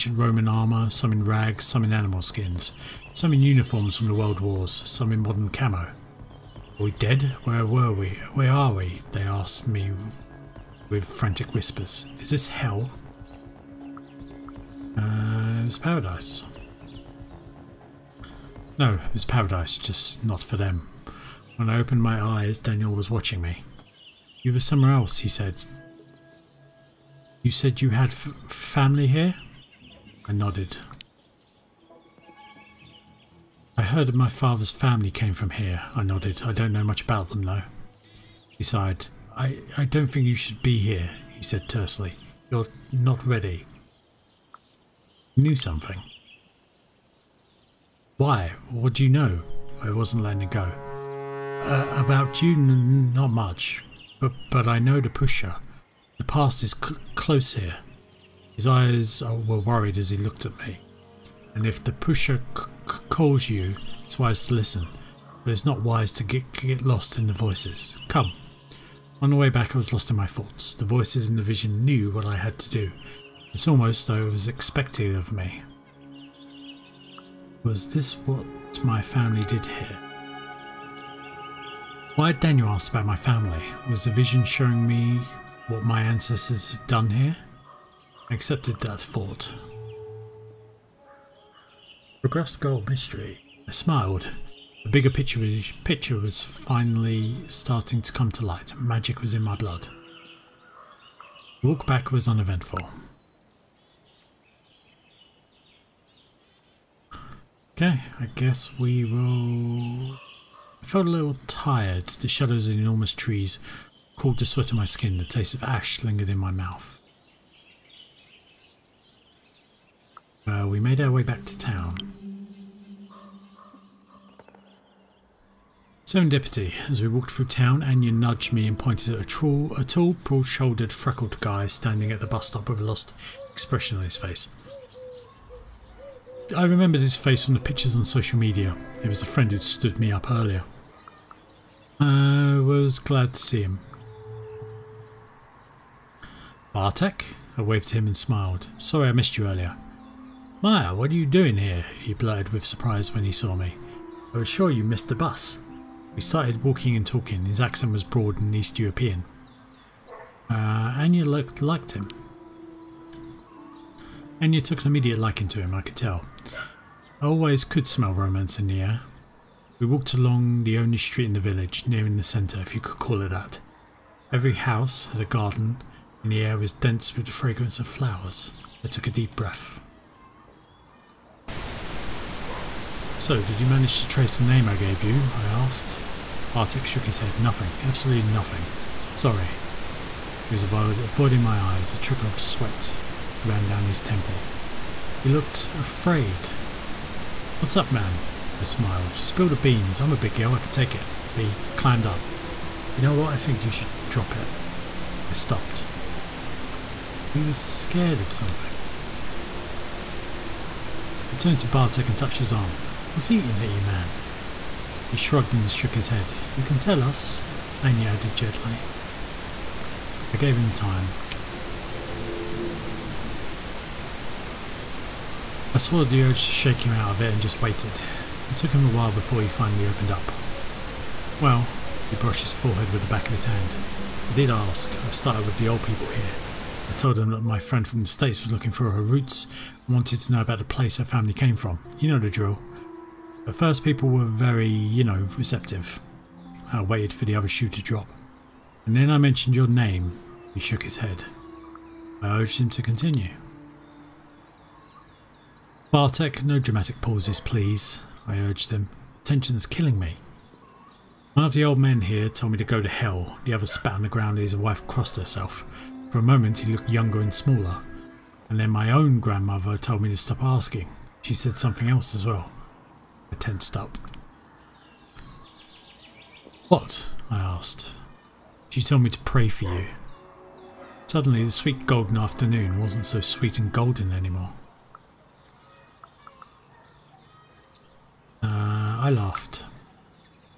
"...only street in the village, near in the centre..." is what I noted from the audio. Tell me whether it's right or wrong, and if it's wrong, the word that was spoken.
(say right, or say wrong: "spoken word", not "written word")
right.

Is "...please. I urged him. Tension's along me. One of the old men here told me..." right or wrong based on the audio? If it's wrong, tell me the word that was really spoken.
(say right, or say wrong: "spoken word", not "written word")
wrong: "killing", not "along".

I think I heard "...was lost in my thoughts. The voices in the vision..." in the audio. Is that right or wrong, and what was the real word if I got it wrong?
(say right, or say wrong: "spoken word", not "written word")
right.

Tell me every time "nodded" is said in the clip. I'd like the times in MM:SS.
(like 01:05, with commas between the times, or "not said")
00:30, 00:36.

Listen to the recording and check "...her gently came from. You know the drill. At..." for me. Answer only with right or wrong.
wrong.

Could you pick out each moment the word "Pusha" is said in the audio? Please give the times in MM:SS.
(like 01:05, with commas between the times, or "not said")
00:55, 01:01.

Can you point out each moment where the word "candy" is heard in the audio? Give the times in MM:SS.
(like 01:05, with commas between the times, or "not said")
not said.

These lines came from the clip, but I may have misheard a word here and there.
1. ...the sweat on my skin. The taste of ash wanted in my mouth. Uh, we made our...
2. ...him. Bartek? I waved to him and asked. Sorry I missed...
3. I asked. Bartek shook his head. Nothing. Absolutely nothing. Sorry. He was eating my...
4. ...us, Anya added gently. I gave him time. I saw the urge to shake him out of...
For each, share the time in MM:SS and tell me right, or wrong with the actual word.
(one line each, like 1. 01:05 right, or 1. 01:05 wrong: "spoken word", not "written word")
1. 01:54 wrong: "lingered", not "wanted"
2. 02:23 wrong: "smiled", not "asked"
3. 03:05 wrong: "avoiding", not "eating"
4. 03:37 right.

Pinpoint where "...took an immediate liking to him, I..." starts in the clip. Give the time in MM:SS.
02:44.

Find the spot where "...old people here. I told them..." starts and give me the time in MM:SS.
03:55.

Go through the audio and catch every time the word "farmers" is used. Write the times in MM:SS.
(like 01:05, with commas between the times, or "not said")
not said.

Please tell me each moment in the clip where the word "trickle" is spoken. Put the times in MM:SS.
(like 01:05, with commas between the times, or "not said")
03:11.